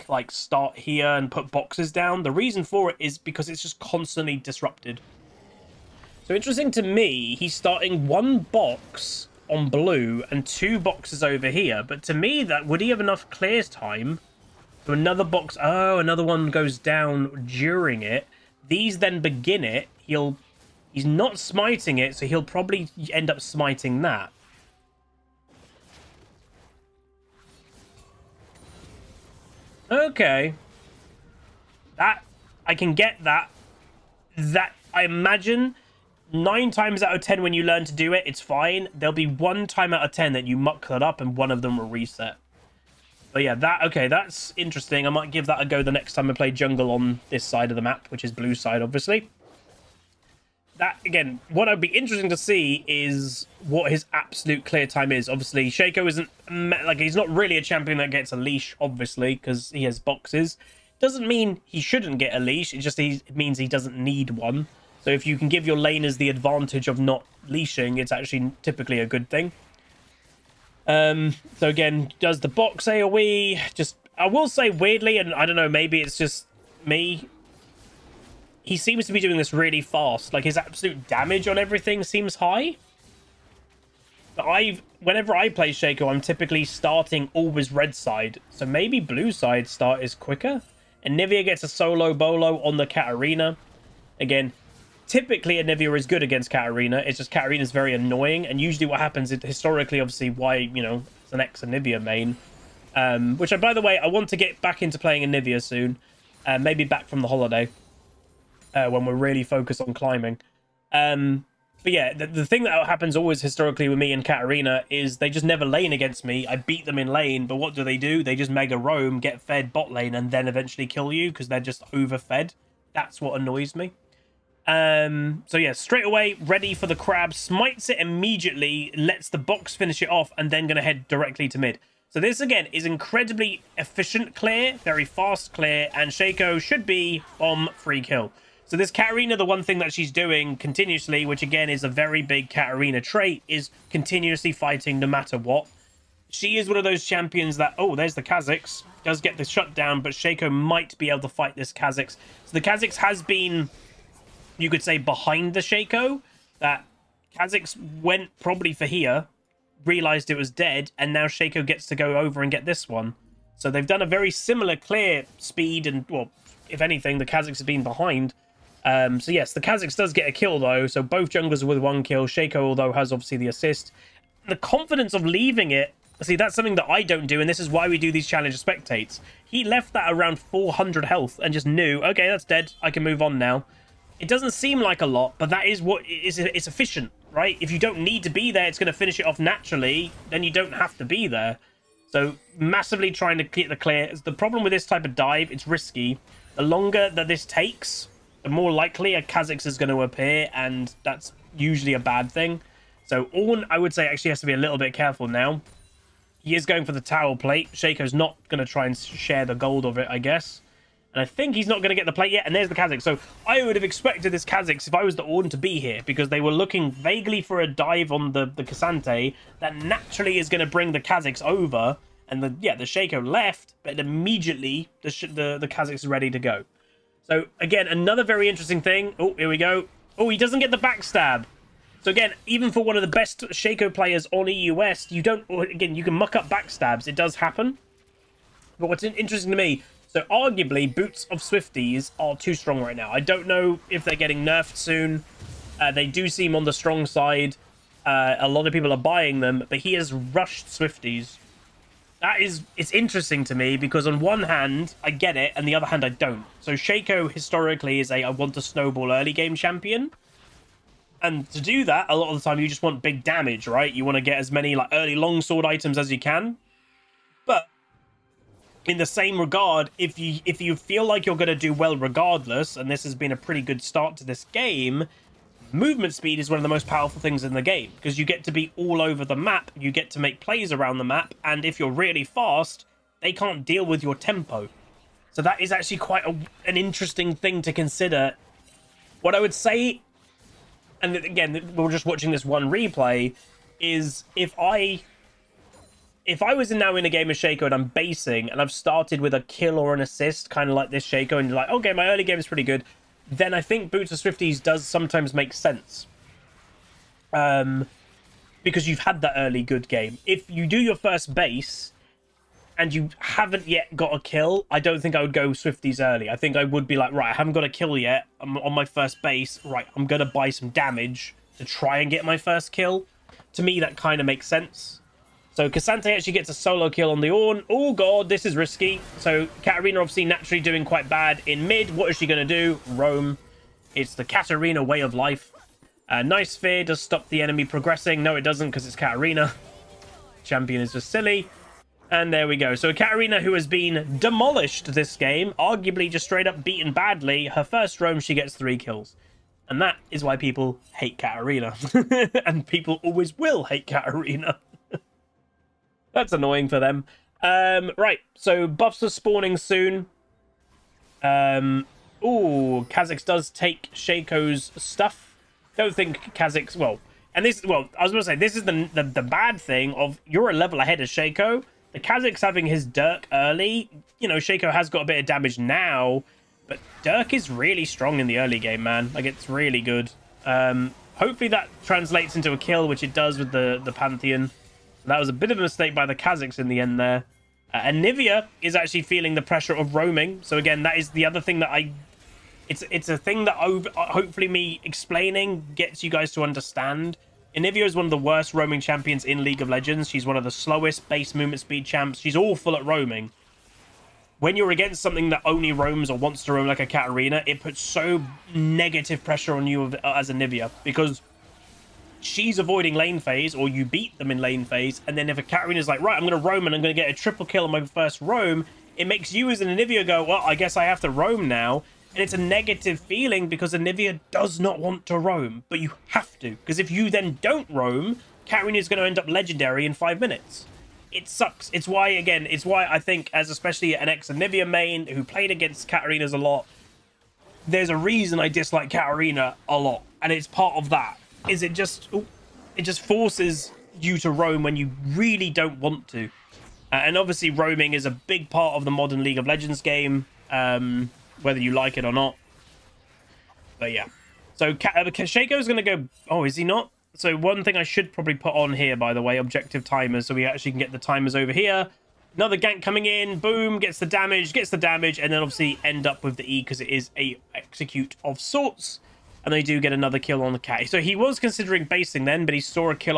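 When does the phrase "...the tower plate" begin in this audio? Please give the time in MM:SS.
03:26.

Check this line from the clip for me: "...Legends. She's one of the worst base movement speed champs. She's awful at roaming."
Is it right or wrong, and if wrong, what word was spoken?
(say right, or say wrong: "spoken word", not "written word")
wrong: "slowest", not "worst".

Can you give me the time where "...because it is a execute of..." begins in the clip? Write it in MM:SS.
07:46.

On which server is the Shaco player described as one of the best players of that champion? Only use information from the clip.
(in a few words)
EU West.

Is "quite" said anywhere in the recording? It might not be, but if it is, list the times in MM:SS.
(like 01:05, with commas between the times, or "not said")
04:45, 05:30.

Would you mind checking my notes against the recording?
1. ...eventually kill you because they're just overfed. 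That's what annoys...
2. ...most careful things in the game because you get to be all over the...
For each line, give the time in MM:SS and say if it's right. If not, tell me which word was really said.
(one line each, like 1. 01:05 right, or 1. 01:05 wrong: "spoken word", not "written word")
1. 02:00 right
2. 04:36 wrong: "powerful", not "careful".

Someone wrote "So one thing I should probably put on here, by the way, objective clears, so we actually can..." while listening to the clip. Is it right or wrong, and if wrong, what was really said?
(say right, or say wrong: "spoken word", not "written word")
wrong: "timers", not "clears".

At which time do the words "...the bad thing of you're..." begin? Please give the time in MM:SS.
06:09.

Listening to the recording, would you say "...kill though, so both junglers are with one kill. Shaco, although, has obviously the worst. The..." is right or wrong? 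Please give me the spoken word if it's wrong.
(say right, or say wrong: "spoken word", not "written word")
wrong: "assist", not "worst".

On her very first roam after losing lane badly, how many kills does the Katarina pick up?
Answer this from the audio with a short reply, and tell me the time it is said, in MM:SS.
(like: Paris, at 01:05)
3, at 05:48.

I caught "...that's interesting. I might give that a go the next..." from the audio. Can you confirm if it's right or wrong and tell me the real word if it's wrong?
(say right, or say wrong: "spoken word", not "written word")
right.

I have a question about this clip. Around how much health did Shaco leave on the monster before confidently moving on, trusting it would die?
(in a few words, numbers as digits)
400.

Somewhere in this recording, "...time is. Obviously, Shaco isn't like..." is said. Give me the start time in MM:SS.
00:54.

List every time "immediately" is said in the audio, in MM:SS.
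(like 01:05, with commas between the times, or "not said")
02:07, 03:43.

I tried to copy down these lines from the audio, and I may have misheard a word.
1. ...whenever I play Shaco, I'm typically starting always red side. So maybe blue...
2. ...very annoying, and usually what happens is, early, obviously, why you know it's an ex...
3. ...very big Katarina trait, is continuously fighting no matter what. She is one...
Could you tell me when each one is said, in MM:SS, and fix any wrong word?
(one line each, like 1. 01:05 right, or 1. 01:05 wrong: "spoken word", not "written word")
1. 01:25 right
2. 01:37 wrong: "historically", not "early"
3. 02:21 right.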